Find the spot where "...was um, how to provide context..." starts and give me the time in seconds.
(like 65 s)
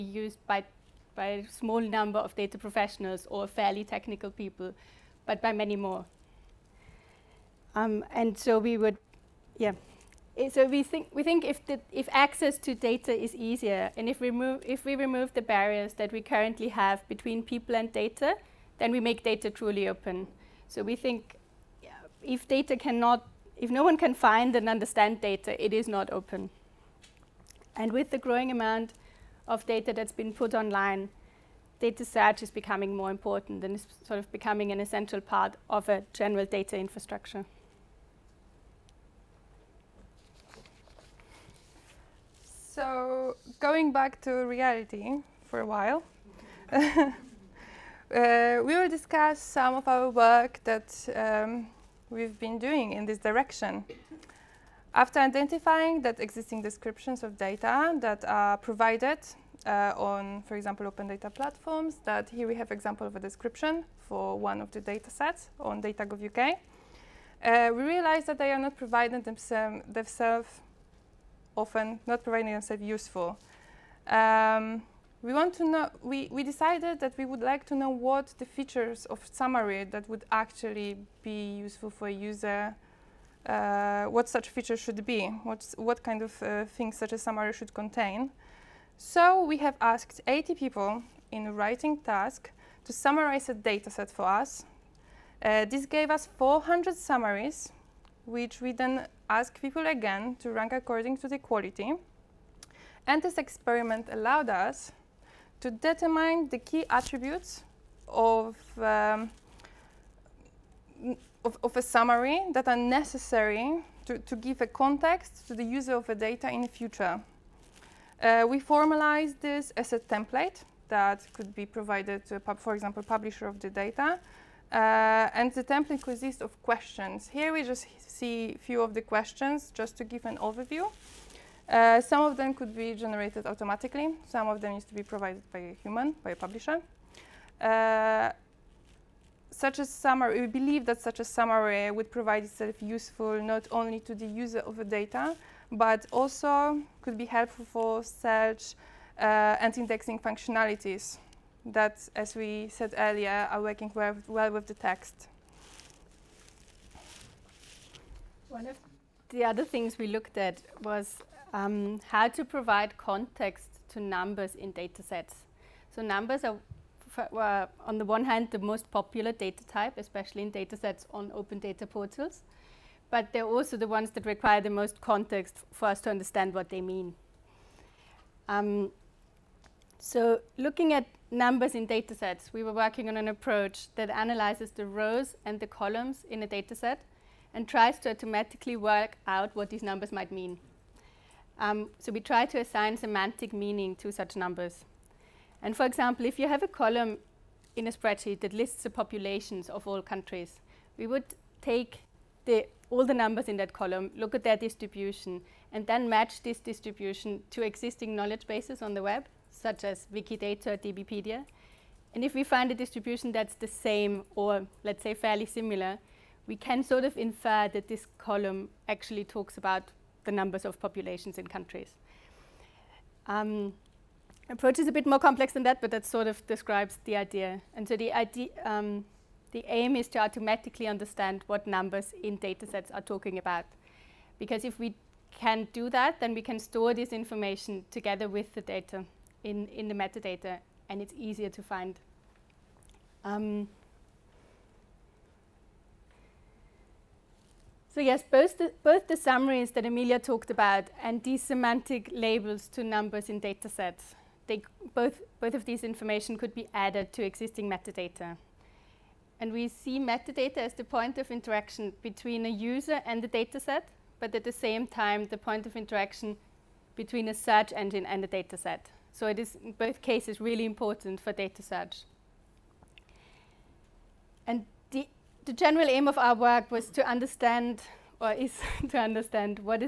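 160 s.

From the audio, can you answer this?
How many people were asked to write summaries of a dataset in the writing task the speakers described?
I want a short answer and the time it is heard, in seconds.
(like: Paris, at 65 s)
80, at 90 s.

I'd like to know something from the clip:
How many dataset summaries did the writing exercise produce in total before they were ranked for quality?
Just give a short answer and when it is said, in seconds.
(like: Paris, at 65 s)
400, at 96 s.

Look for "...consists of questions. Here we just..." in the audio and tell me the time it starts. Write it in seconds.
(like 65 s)
126 s.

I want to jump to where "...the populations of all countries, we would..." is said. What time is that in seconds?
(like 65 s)
198 s.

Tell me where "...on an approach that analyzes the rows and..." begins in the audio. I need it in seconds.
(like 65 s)
183 s.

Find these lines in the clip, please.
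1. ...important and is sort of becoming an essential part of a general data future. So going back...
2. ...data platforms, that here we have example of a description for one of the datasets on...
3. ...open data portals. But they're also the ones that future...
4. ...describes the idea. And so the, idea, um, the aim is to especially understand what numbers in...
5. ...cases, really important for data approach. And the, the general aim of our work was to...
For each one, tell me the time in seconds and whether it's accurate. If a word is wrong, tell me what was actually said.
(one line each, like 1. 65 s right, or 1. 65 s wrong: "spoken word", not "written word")
1. 33 s wrong: "infrastructure", not "future"
2. 61 s right
3. 171 s wrong: "require", not "future"
4. 226 s wrong: "automatically", not "especially"
5. 270 s wrong: "search", not "approach".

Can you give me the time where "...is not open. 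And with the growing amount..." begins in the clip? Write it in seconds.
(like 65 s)
25 s.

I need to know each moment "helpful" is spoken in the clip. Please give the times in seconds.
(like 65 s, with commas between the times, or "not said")
147 s.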